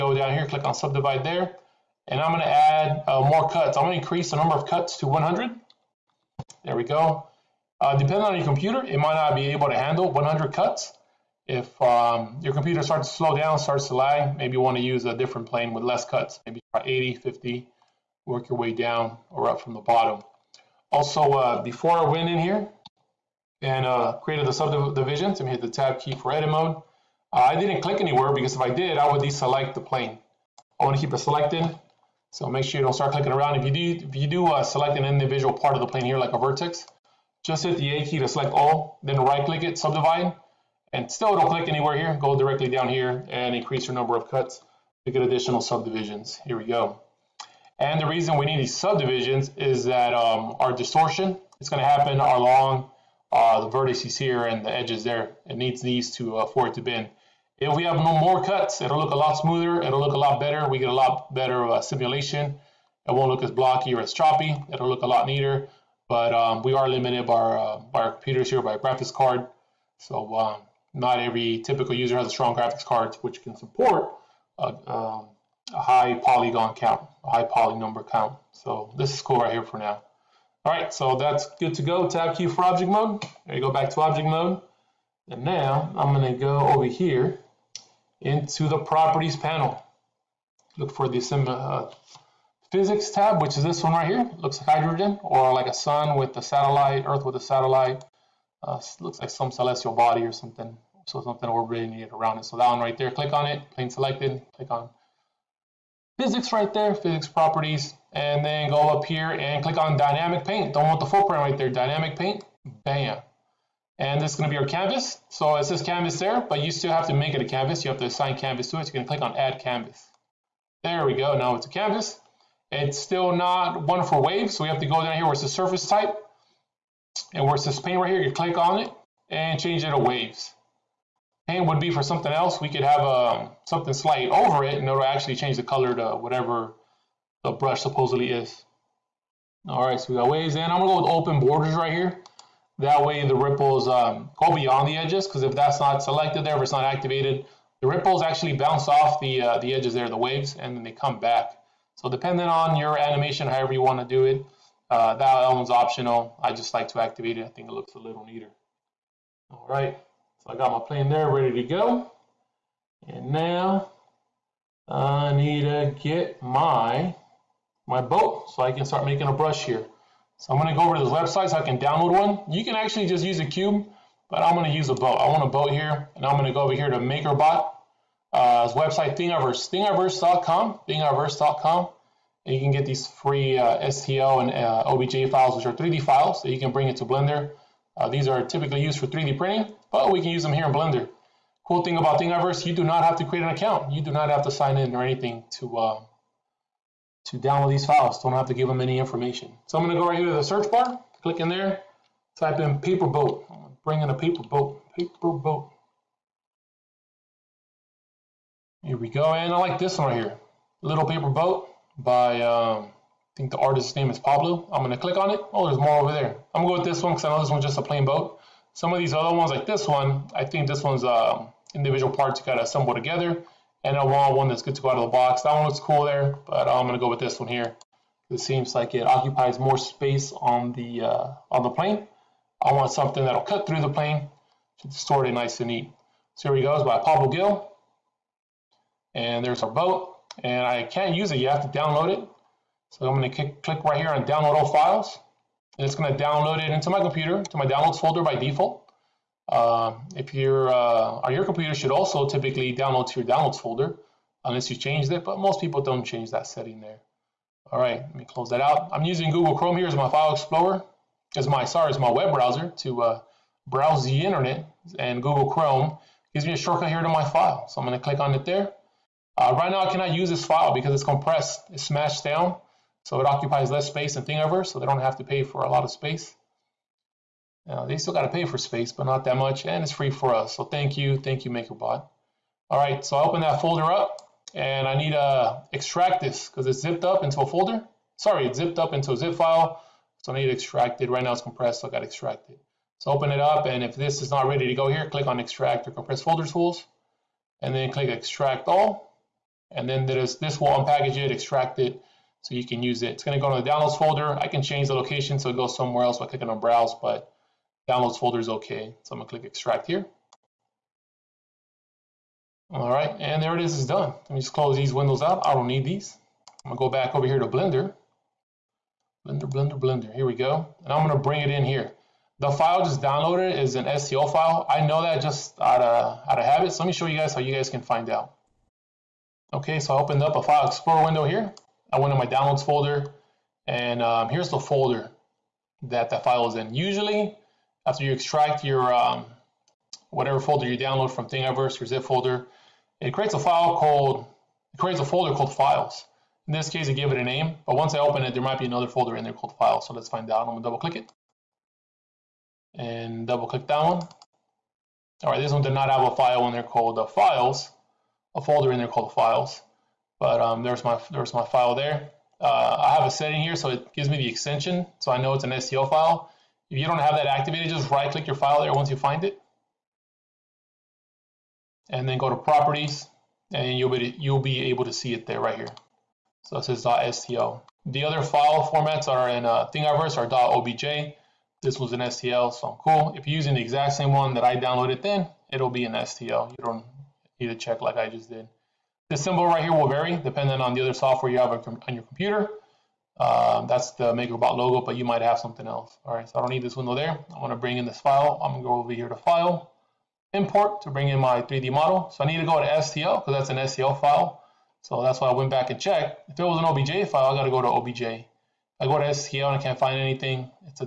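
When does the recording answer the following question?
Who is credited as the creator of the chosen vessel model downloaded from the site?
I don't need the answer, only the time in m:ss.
3:57.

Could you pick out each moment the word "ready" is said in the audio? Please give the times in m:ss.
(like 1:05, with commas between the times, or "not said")
2:41, 4:54.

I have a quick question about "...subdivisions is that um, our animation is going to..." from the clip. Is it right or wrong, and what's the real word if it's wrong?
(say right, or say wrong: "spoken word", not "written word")
wrong: "distortion", not "animation".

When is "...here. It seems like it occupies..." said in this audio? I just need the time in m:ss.
3:47.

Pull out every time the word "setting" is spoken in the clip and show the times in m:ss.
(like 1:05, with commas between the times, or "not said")
4:16, 6:03.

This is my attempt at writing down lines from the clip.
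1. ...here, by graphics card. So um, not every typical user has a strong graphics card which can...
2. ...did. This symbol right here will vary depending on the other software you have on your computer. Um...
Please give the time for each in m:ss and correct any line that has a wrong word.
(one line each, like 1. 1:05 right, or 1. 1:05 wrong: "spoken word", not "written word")
1. 1:08 right
2. 6:28 right.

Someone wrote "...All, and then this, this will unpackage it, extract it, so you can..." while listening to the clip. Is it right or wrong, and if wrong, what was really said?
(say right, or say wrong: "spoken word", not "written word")
right.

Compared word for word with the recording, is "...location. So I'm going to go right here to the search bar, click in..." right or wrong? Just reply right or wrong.
wrong.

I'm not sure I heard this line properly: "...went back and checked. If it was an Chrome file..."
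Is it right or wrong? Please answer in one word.
wrong.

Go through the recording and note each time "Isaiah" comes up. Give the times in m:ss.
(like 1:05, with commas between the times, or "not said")
not said.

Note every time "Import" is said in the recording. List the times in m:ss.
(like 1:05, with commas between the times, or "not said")
6:40.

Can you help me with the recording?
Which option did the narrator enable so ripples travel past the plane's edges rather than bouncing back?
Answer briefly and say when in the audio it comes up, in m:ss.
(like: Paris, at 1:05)
Open borders, at 2:21.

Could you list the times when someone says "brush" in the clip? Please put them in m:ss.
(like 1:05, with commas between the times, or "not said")
2:17, 2:49.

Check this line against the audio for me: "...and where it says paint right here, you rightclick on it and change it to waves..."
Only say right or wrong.
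wrong.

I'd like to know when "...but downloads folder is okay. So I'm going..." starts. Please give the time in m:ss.
5:07.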